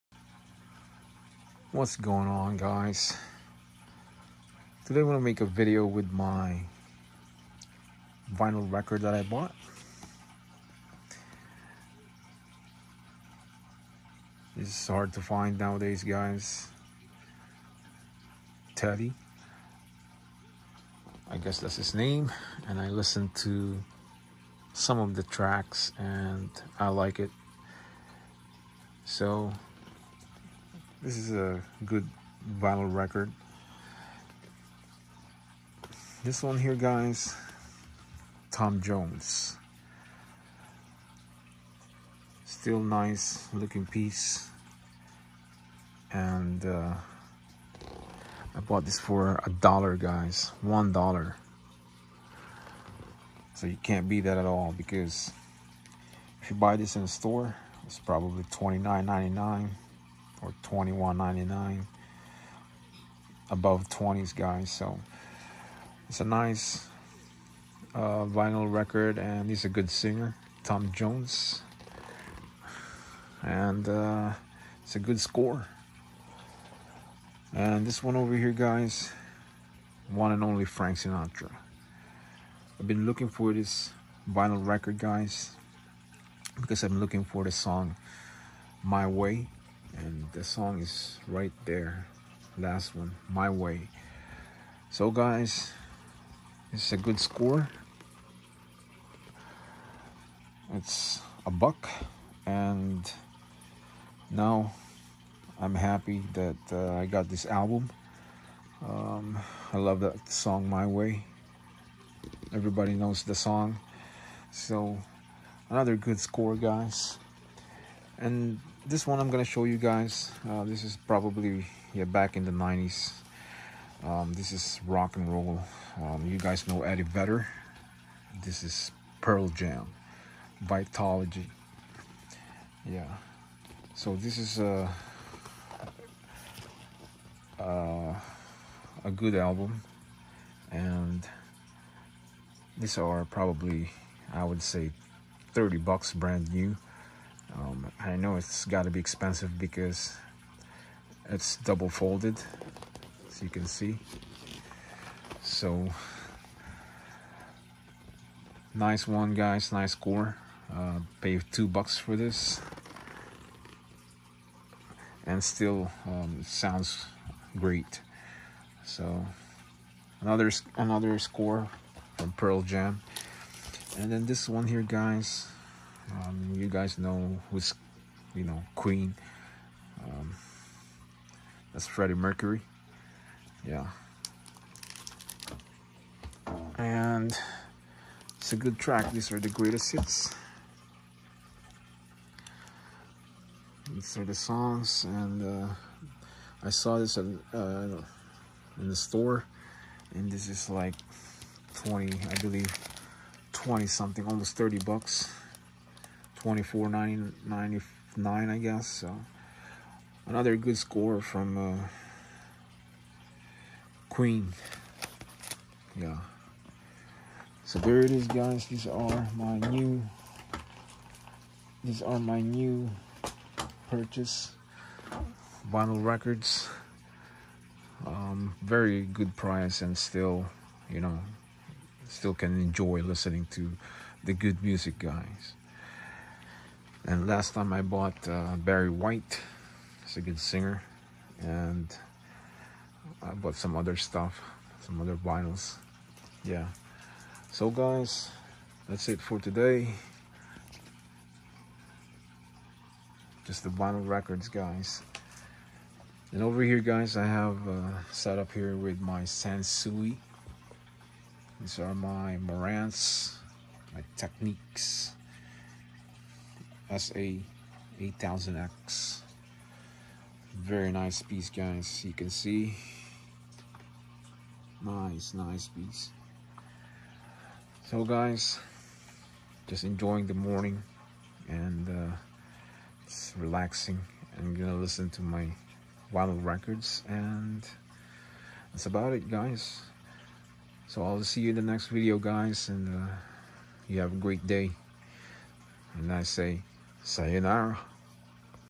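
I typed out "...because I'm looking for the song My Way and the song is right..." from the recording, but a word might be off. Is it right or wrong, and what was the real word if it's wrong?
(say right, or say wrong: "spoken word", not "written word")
right.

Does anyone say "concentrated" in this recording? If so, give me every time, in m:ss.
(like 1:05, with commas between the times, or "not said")
not said.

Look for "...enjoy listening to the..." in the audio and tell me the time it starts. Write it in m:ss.
3:52.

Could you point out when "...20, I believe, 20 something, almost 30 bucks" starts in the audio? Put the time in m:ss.
3:21.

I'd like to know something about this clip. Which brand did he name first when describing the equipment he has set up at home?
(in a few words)
Sansui.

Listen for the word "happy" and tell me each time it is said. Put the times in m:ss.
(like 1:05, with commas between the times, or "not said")
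1:45.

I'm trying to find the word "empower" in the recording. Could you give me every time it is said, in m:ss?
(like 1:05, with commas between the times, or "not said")
not said.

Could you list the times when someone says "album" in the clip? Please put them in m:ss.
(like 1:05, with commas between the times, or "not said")
1:47, 2:19.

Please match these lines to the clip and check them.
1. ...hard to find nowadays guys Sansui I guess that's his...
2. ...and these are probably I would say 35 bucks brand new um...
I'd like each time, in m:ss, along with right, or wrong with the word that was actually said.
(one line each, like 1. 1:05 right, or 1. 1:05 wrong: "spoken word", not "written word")
1. 0:14 wrong: "Teddy", not "Sansui"
2. 2:20 wrong: "30", not "35".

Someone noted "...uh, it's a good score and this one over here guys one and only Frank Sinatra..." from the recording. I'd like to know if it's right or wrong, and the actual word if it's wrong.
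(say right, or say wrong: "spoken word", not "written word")
right.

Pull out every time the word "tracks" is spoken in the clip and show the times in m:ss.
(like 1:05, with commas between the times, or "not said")
0:25, 3:08.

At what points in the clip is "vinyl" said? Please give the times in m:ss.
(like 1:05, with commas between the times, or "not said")
0:08, 0:32, 1:08, 1:24, 3:45, 4:05, 4:13, 4:46.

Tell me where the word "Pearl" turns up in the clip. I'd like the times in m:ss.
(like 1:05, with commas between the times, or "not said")
2:09, 2:52.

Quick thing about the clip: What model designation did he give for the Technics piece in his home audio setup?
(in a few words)
SA8000X.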